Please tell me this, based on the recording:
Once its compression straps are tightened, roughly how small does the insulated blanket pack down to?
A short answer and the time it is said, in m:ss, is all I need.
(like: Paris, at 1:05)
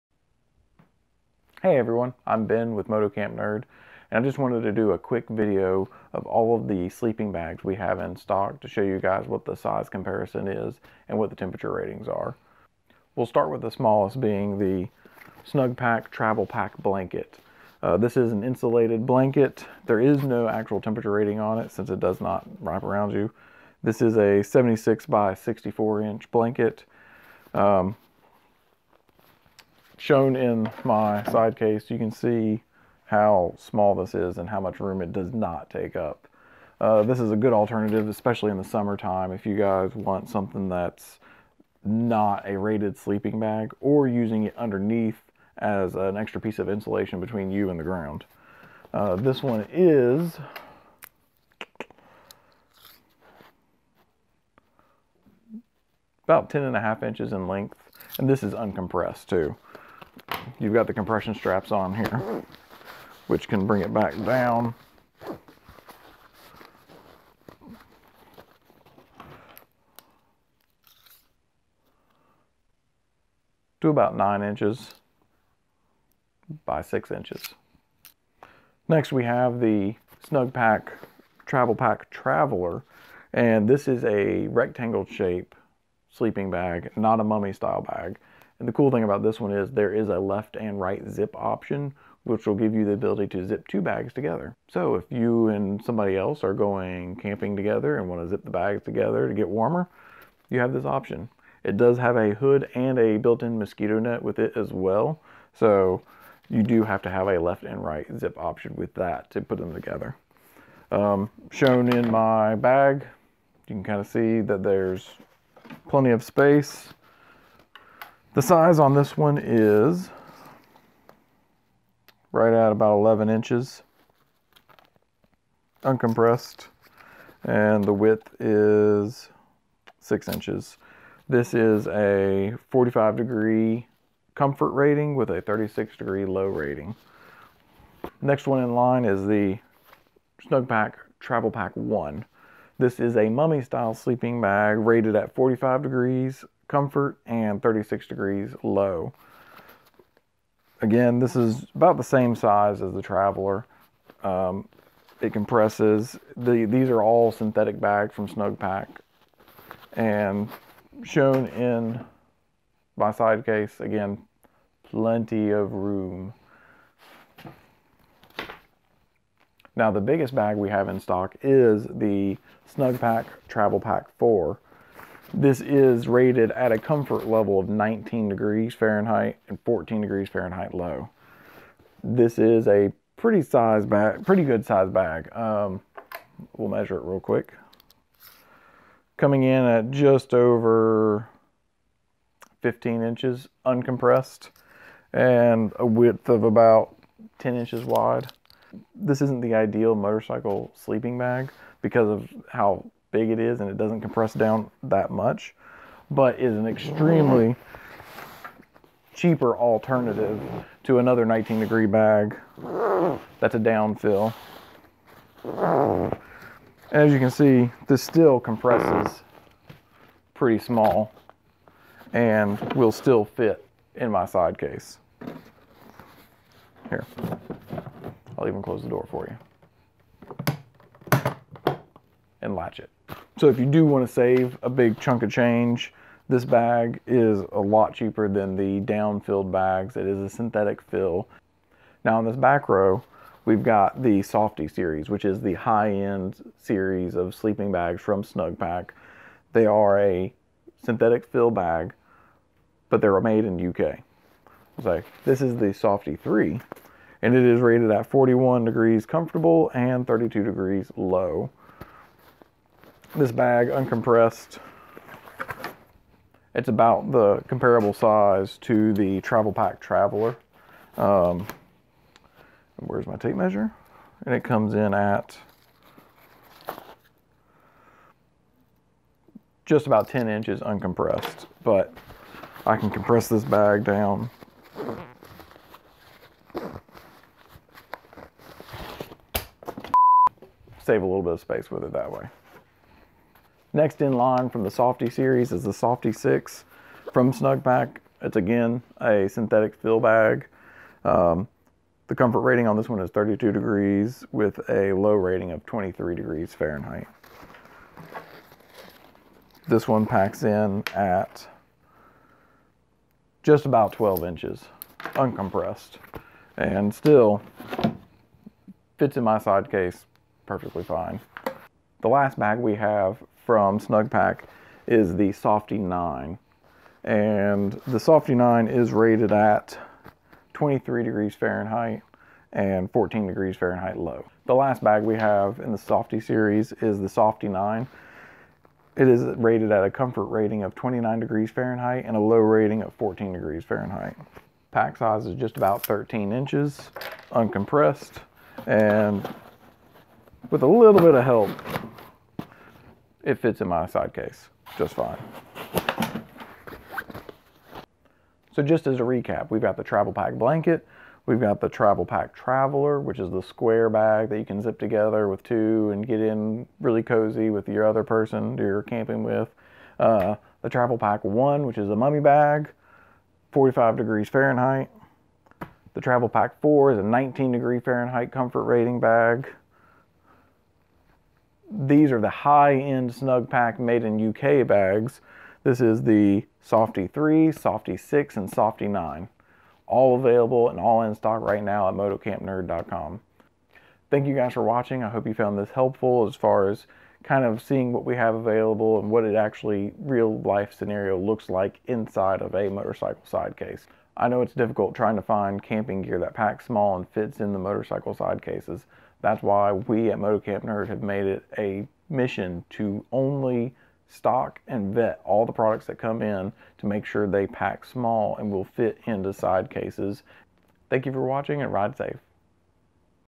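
9 by 6 inches, at 1:14.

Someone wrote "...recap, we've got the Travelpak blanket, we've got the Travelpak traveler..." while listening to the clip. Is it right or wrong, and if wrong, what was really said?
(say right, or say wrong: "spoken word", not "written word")
right.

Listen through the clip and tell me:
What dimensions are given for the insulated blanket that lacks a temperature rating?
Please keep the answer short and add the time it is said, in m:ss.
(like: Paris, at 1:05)
76 by 64 inches, at 0:24.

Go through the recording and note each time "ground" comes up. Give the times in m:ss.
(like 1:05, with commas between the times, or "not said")
0:47.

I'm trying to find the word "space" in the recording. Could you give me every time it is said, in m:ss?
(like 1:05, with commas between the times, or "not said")
1:56, 4:51.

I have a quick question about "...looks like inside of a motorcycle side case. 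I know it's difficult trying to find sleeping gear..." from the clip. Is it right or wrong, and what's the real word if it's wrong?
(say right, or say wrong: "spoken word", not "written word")
wrong: "camping", not "sleeping".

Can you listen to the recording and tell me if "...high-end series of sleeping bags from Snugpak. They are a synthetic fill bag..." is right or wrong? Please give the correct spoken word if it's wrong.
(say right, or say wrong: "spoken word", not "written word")
right.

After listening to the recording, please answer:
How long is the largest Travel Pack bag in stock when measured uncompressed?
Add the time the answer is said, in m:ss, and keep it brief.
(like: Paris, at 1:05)
Just over 15 inches, at 3:09.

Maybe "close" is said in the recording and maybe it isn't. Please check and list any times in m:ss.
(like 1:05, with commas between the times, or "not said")
3:48.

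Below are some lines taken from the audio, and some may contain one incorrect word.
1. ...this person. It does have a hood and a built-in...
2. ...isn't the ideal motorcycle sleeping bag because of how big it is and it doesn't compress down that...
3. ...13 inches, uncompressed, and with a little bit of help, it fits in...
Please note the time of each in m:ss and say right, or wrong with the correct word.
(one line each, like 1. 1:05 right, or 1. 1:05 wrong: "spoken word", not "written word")
1. 1:40 wrong: "option", not "person"
2. 3:19 right
3. 5:45 right.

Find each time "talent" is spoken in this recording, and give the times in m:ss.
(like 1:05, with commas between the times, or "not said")
not said.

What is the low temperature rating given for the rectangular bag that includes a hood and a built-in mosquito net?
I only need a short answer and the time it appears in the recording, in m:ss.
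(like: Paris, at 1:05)
36 degrees, at 2:15.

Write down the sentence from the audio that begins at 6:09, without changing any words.
Uh, the Travelpak one, which is a mummy bag, 45 degrees Fahrenheit.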